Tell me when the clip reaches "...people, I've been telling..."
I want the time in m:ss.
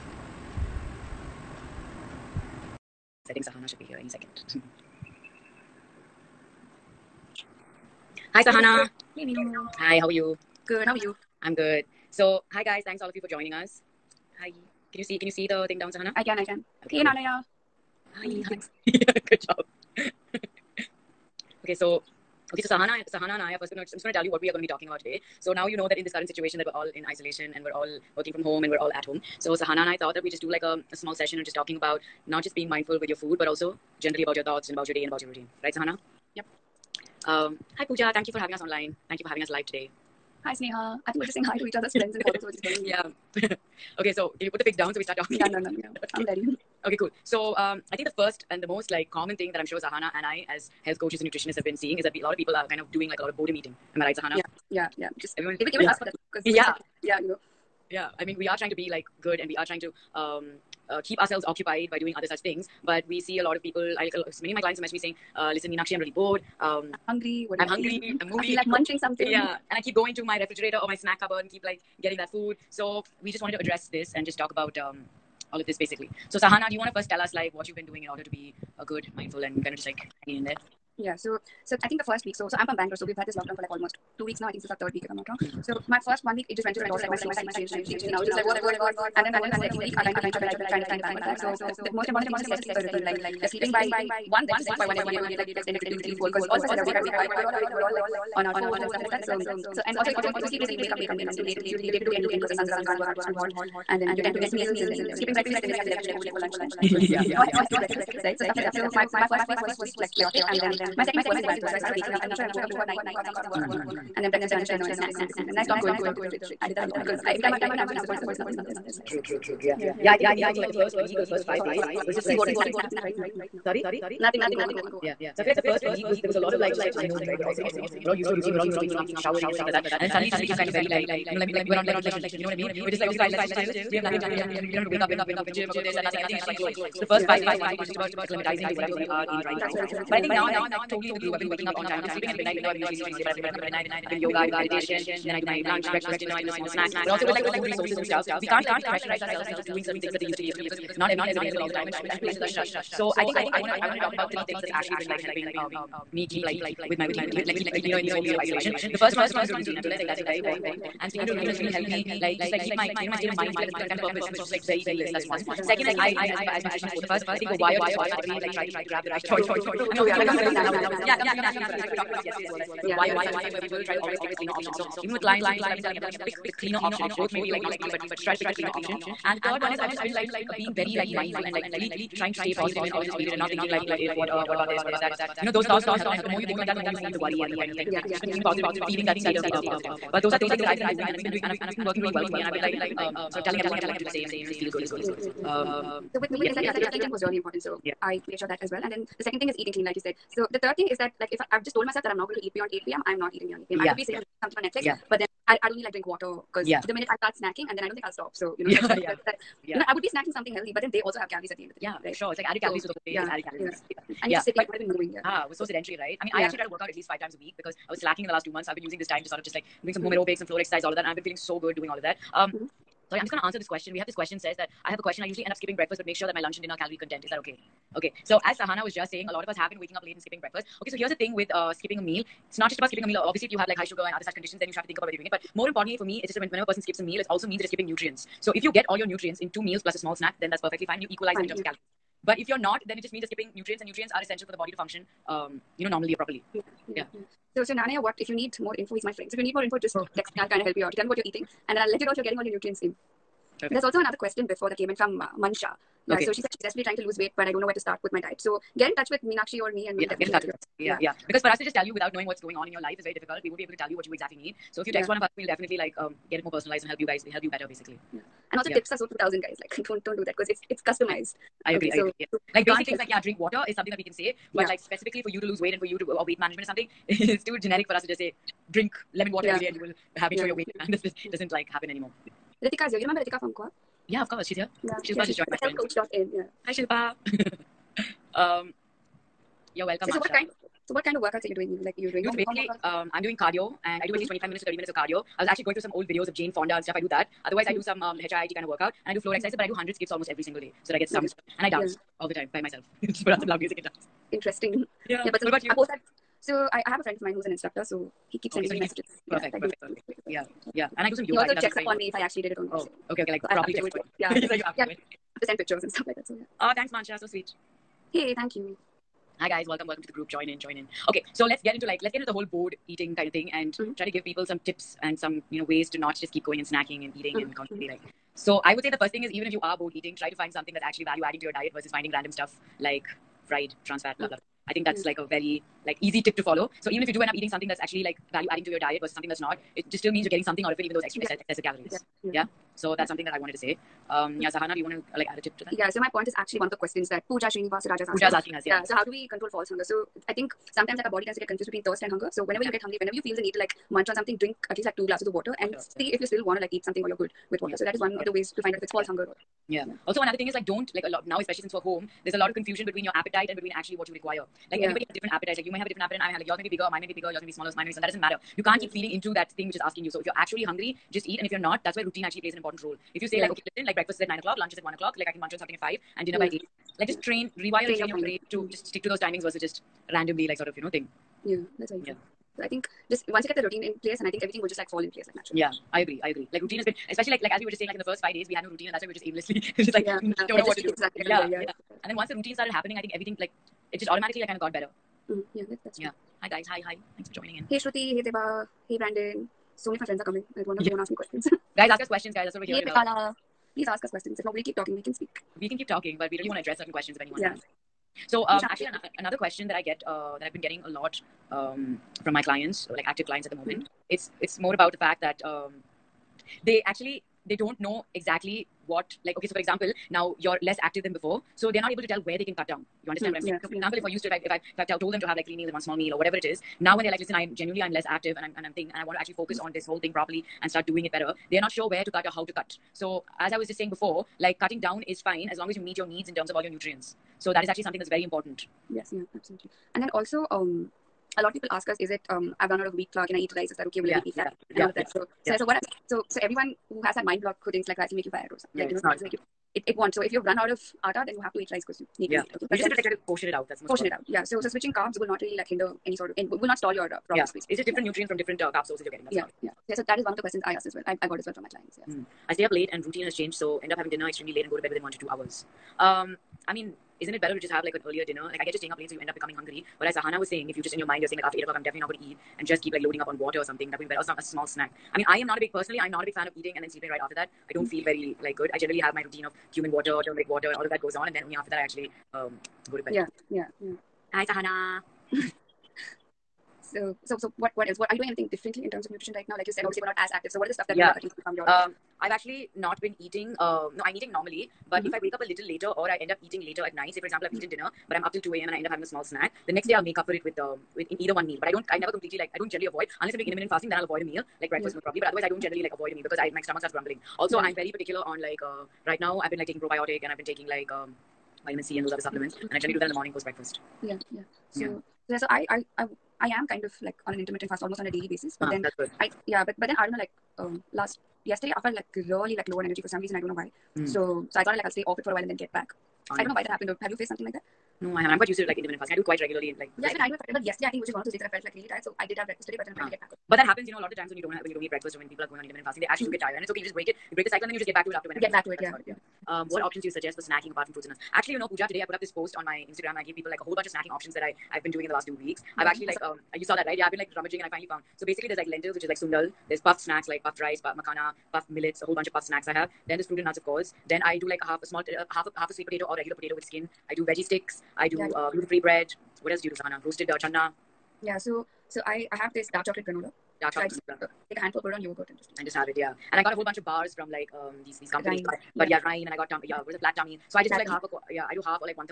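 2:55.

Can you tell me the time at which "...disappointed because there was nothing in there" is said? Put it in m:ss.
1:57.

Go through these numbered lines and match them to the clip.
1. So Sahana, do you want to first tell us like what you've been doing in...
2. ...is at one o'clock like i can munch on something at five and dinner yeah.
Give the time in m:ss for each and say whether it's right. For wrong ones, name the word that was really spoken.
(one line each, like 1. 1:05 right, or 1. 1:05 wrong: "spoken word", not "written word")
1. 1:16 right
2. 6:14 right.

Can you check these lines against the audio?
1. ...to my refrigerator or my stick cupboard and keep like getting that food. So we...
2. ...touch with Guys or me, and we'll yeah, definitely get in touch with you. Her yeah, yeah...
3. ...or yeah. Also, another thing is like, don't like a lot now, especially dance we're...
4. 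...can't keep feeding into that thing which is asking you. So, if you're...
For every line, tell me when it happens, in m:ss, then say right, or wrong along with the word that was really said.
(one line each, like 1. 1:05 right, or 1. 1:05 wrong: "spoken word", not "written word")
1. 1:10 wrong: "snack", not "stick"
2. 4:18 wrong: "Meenakshi", not "Guys"
3. 5:59 wrong: "since", not "dance"
4. 6:08 right.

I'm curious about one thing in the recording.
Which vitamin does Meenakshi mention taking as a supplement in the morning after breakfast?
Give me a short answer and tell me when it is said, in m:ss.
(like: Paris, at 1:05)
Vitamin C, at 8:31.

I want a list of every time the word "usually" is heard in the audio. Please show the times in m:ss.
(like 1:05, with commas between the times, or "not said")
2:22, 3:45.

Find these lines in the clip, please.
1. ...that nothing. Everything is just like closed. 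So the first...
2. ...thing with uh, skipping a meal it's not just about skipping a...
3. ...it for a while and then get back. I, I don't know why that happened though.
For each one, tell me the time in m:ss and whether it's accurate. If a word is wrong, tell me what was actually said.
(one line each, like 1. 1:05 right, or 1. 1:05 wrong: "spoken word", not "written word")
1. 2:15 right
2. 3:51 right
3. 8:45 right.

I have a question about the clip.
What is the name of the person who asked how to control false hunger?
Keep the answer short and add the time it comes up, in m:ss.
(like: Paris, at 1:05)
Pooja Srinivasaraja, at 5:47.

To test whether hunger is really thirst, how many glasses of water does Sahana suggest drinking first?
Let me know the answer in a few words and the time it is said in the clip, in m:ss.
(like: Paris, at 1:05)
2, at 5:54.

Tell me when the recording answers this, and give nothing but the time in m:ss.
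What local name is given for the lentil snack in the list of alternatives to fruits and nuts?
9:09.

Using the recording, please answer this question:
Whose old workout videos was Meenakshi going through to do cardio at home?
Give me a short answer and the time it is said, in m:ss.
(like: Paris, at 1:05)
Jane Fonda, at 4:56.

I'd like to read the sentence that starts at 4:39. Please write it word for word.
every day and you will have make yeah.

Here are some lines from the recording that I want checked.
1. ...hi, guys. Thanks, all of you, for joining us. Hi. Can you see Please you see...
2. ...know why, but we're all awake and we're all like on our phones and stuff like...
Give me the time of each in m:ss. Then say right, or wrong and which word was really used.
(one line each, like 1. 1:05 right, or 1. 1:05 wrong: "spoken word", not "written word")
1. 0:12 wrong: "Can", not "Please"
2. 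1:37 right.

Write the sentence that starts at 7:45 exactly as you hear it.
Um, I mean, isn't it better to just have like an earlier dinner?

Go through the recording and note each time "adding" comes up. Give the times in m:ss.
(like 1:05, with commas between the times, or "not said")
5:31, 5:38.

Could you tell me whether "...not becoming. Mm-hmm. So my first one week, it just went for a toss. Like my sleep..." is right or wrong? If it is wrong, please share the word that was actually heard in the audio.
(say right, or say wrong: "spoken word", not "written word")
wrong: "wrong", not "becoming".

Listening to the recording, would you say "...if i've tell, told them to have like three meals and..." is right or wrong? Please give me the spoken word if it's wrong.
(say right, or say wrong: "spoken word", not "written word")
right.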